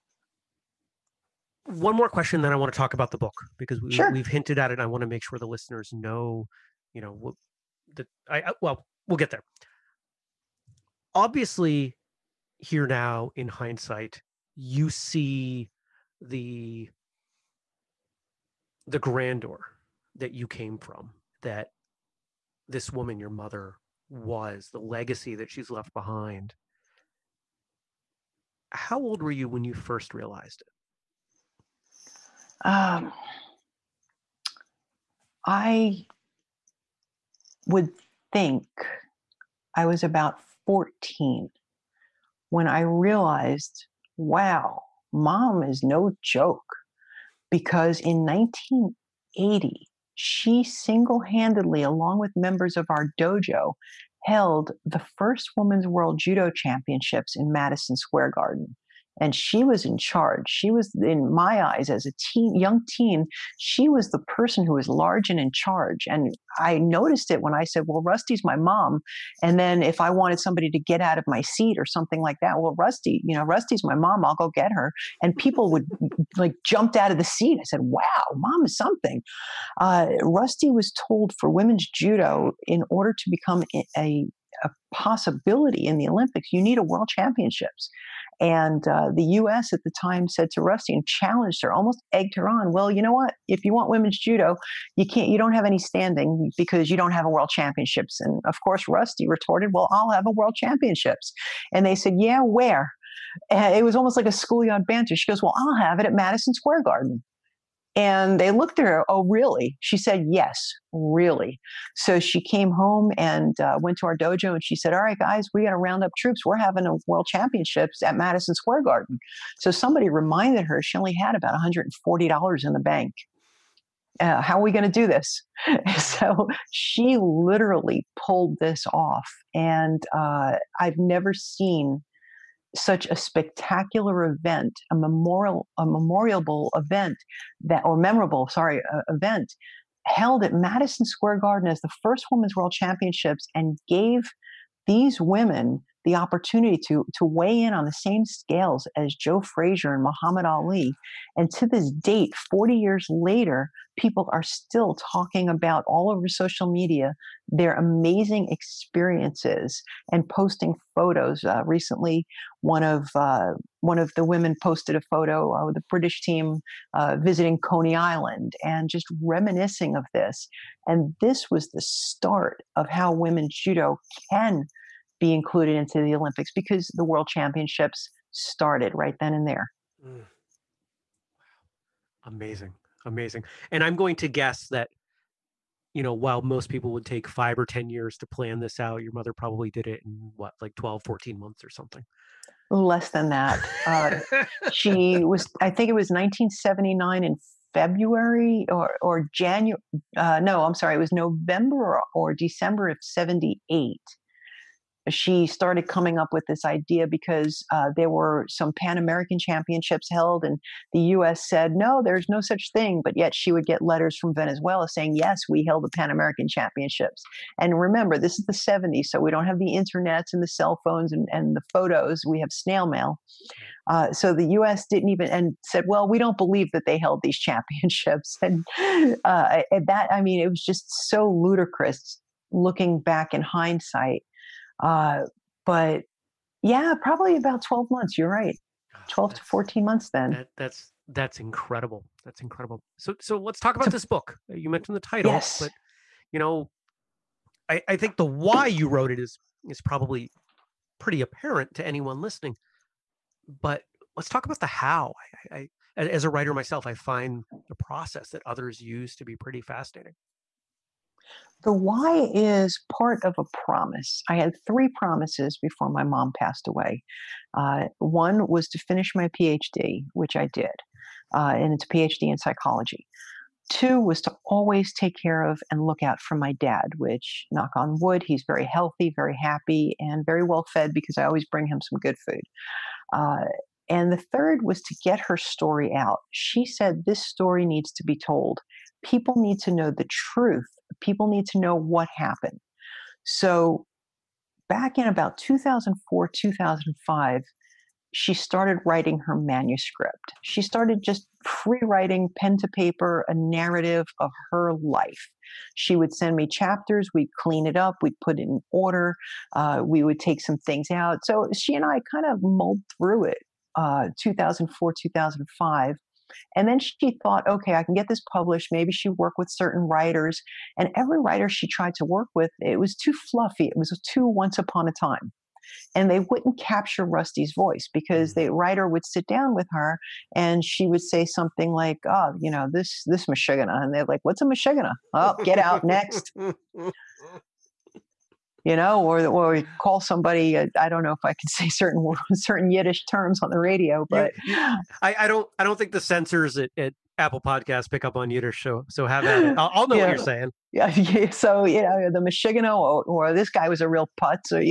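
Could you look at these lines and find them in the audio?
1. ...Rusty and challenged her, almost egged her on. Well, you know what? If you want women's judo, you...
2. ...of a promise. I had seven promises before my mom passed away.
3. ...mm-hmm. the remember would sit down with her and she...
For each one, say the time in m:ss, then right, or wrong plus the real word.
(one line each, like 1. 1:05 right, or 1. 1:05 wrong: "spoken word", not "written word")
1. 1:30 right
2. 4:23 wrong: "three", not "seven"
3. 5:28 wrong: "writer", not "remember".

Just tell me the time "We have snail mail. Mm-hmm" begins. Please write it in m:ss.
3:42.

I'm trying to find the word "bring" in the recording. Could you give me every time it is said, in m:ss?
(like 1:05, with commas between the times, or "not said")
4:41.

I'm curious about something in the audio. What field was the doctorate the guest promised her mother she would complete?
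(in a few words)
psychology.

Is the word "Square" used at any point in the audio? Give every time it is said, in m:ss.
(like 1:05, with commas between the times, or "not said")
0:57, 1:46, 1:58, 2:21.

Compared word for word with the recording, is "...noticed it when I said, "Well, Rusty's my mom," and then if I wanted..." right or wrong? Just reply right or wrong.
right.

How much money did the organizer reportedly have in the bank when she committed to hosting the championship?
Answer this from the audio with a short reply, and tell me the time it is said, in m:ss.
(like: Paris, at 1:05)
$140, at 2:01.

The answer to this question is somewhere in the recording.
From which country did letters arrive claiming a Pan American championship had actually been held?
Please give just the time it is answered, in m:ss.
3:34.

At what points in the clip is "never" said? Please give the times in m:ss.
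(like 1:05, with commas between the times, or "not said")
2:10.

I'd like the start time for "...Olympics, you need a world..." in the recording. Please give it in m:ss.
1:26.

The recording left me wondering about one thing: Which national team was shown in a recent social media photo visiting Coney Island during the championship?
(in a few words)
British.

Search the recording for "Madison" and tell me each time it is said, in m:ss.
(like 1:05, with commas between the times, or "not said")
0:57, 1:46, 1:58, 2:20.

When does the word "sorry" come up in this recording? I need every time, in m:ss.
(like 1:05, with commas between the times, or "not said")
2:18, 3:20.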